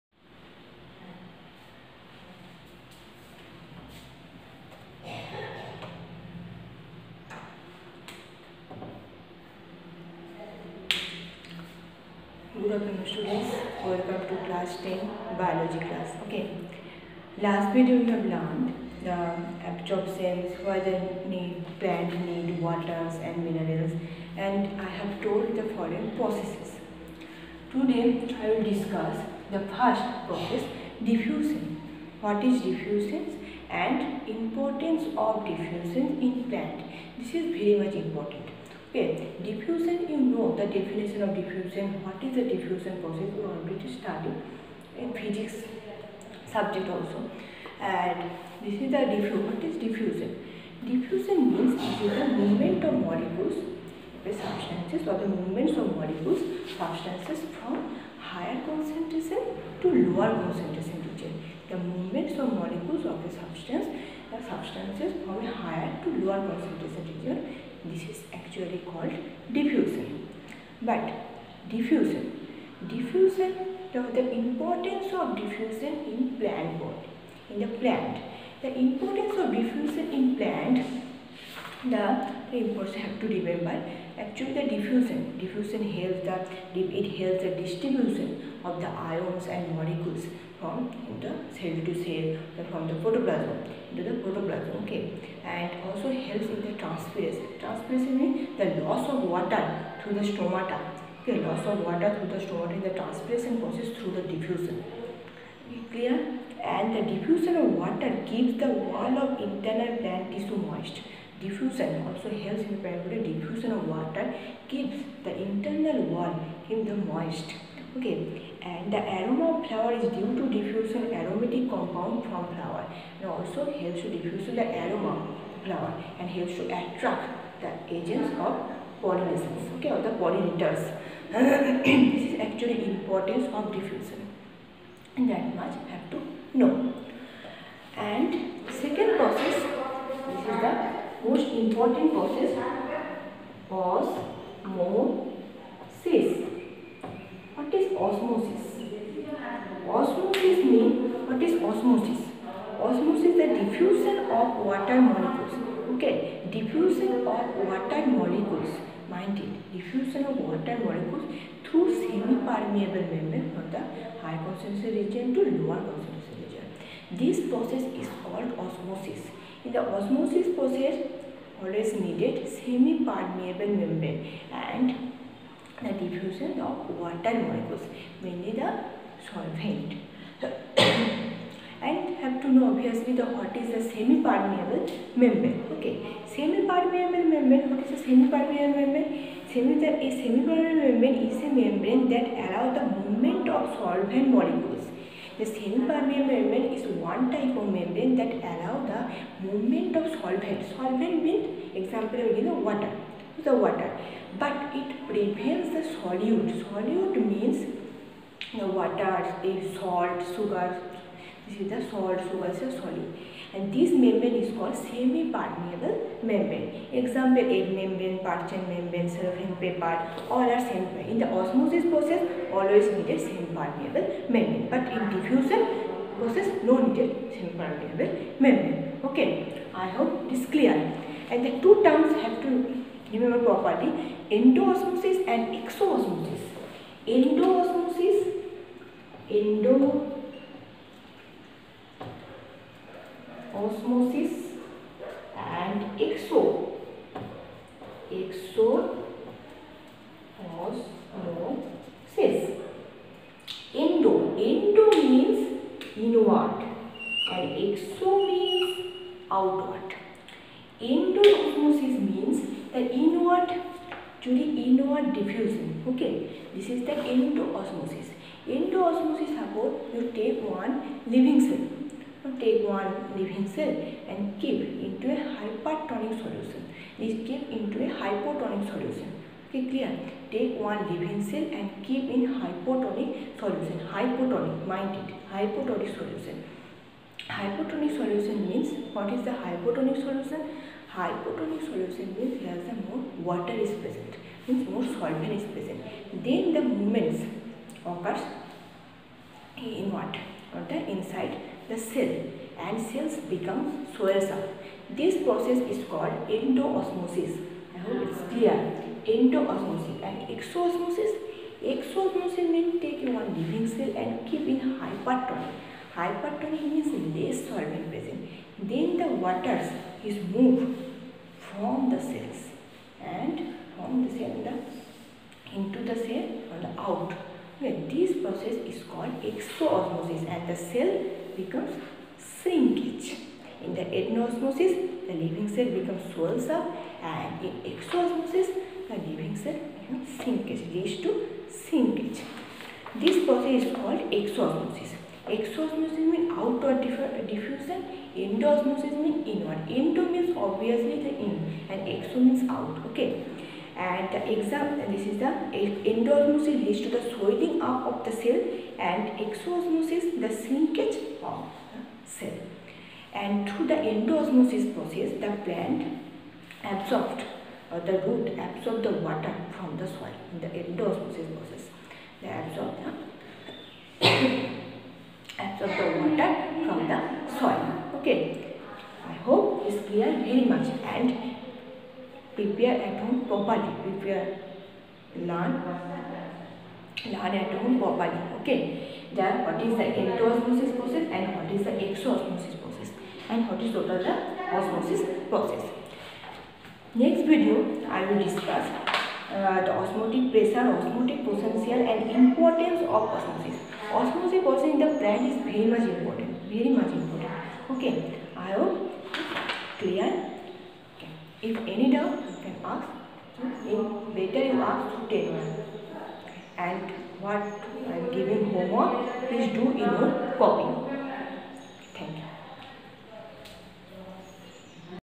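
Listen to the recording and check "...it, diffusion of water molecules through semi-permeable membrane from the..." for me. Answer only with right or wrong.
right.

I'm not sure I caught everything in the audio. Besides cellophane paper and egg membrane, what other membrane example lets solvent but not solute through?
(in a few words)
parchment membrane.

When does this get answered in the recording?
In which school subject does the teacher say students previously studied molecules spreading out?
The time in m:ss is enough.
0:45.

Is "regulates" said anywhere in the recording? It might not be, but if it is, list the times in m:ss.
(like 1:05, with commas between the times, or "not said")
not said.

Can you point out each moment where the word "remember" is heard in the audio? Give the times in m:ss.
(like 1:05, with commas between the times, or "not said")
1:23, 3:53.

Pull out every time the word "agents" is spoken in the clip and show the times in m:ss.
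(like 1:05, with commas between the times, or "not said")
2:07.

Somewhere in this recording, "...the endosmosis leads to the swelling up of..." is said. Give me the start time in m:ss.
5:55.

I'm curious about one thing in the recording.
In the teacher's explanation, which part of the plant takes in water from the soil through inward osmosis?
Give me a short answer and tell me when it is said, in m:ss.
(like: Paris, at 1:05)
the root, at 6:07.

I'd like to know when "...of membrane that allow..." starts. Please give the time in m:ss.
3:17.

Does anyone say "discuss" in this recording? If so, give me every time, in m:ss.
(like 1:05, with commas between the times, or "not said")
0:28, 6:38.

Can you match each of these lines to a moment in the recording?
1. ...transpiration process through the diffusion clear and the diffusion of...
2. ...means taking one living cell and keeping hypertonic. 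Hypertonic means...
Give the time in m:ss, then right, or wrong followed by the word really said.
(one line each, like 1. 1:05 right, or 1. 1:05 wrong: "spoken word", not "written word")
1. 1:43 right
2. 5:12 right.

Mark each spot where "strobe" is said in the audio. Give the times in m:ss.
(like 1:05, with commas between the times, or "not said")
not said.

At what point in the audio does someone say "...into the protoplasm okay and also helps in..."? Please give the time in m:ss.
1:33.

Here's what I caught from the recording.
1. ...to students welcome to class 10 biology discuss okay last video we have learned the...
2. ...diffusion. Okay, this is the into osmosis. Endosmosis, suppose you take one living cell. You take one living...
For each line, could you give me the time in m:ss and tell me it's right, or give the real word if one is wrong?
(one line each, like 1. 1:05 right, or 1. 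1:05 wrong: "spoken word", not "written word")
1. 0:12 wrong: "class", not "discuss"
2. 4:25 right.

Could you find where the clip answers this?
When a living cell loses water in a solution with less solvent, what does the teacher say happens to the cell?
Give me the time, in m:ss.
5:32.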